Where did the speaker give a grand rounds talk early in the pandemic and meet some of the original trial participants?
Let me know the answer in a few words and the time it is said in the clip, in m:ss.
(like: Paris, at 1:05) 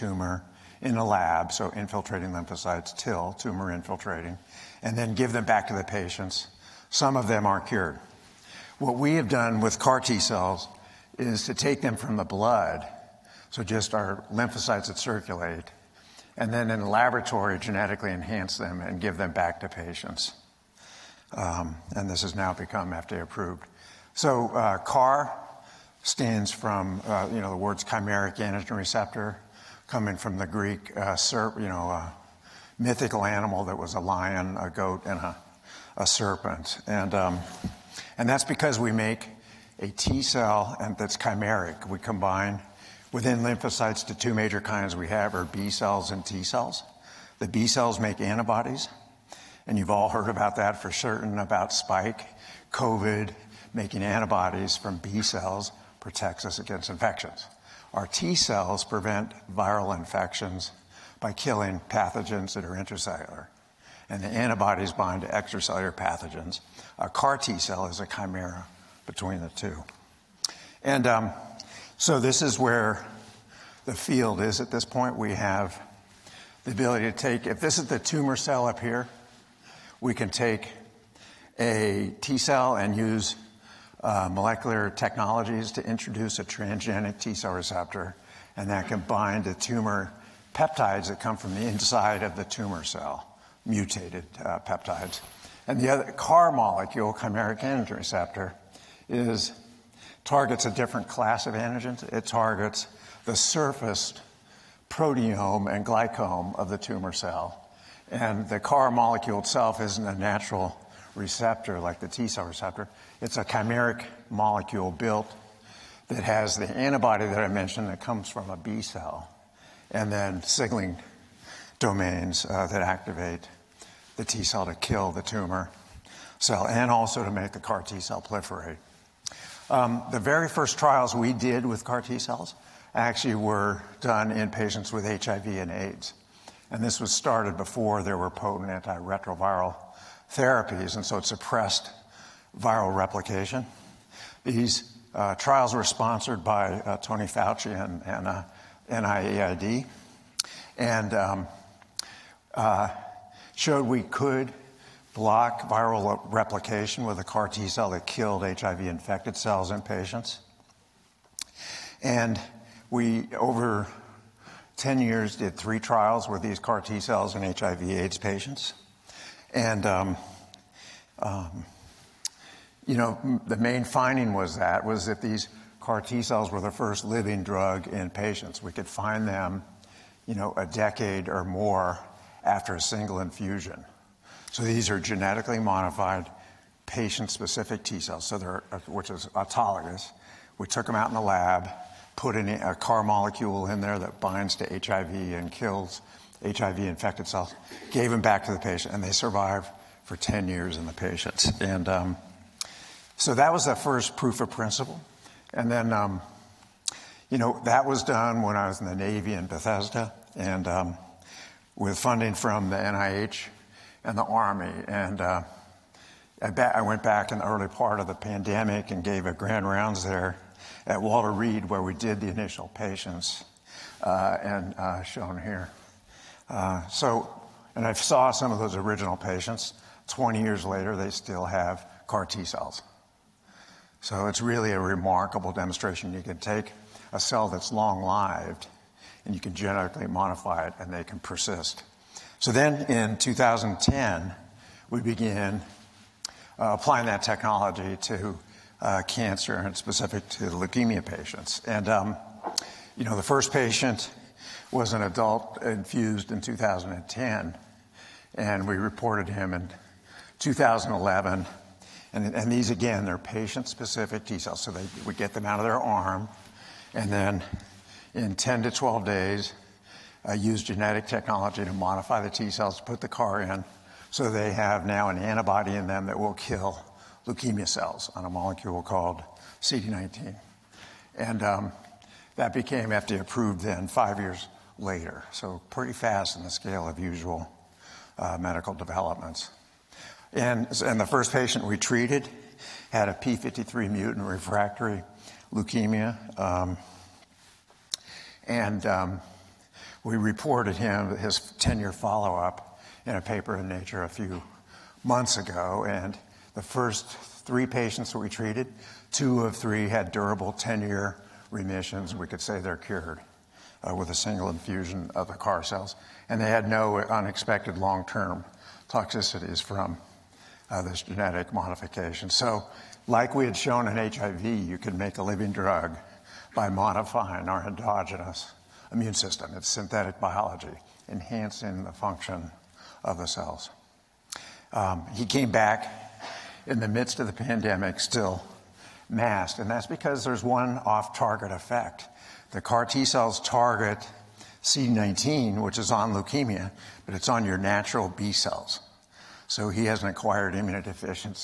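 Walter Reed, at 3:41.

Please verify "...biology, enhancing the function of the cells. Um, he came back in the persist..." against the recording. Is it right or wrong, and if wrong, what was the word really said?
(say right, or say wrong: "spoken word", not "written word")
wrong: "midst", not "persist".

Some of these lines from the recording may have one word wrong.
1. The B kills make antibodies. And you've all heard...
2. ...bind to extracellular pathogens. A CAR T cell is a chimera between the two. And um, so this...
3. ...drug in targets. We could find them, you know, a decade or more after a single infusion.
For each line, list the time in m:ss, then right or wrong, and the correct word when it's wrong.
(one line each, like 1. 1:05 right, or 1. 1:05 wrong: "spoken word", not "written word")
1. 0:47 wrong: "cells", not "kills"
2. 1:04 right
3. 2:57 wrong: "patients", not "targets".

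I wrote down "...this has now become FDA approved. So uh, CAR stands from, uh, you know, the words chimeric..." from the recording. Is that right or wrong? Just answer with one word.
right.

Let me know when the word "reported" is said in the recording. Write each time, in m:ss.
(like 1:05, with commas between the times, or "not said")
4:18, 5:00.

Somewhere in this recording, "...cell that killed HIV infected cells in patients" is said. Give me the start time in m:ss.
2:37.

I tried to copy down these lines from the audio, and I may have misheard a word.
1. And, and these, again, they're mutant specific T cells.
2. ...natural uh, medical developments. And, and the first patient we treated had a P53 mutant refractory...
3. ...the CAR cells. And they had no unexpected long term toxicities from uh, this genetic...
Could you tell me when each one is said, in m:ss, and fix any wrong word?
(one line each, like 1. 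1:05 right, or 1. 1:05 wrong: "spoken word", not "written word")
1. 4:22 wrong: "patient", not "mutant"
2. 4:46 wrong: "usual", not "natural"
3. 5:15 right.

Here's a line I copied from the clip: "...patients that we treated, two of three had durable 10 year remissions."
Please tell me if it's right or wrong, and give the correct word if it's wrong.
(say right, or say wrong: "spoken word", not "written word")
right.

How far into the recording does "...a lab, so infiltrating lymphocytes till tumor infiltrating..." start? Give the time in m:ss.
0:00.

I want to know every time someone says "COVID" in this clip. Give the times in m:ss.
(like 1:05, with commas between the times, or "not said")
0:52.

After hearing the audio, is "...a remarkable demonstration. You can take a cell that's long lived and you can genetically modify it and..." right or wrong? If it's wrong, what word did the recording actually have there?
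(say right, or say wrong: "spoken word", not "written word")
right.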